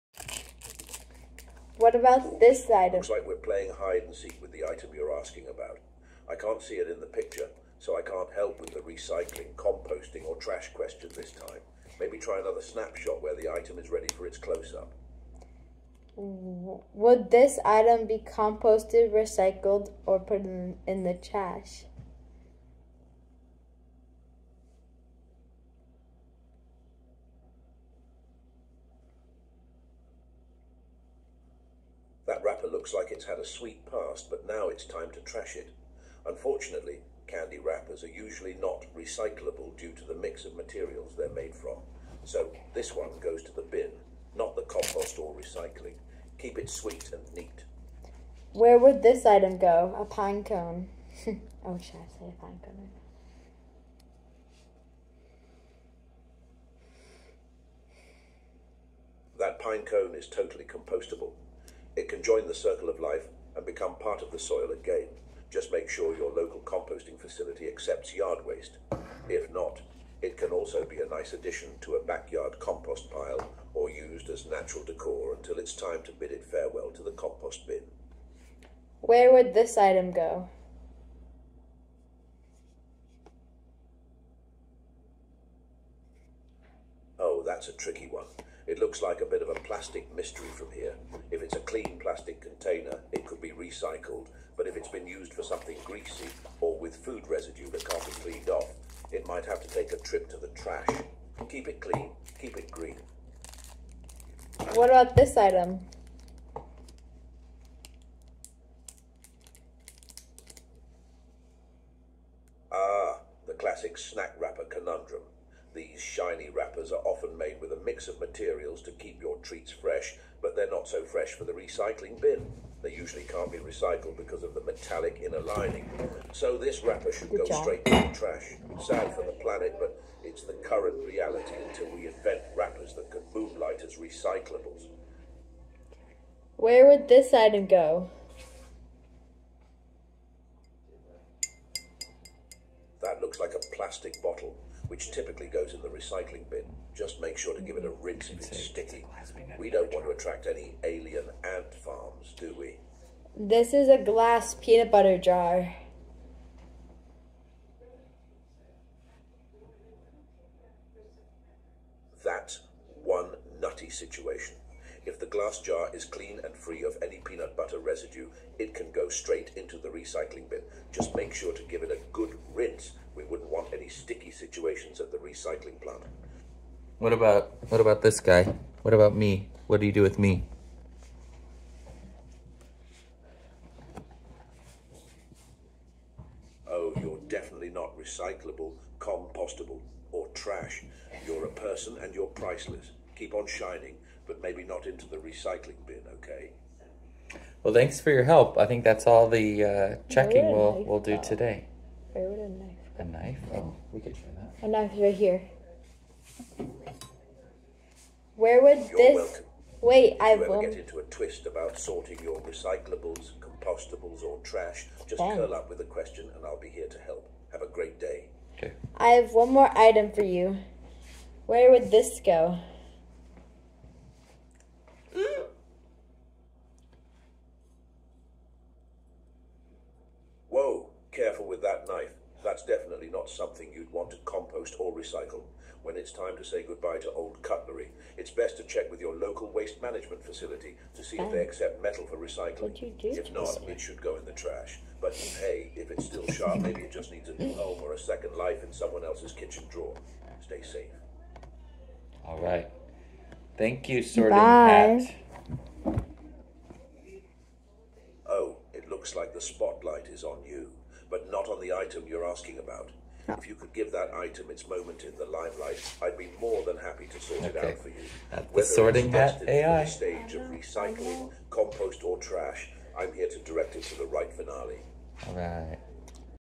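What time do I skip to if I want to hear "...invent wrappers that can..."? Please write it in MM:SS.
02:12.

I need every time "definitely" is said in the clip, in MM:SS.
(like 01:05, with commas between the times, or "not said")
03:07, 03:52.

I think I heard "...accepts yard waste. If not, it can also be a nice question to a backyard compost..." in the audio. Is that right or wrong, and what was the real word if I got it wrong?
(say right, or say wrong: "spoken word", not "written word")
wrong: "addition", not "question".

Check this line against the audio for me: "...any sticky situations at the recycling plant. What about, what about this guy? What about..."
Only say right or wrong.
right.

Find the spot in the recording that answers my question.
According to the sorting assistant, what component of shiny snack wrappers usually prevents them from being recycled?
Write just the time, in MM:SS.
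02:04.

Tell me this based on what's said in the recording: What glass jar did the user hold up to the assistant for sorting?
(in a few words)
peanut butter jar.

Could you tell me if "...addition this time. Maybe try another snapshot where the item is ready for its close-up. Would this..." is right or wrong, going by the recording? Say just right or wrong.
wrong.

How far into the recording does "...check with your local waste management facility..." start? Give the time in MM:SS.
03:58.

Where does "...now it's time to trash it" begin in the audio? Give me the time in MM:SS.
00:34.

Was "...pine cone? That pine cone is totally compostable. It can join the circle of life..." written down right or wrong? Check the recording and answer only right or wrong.
right.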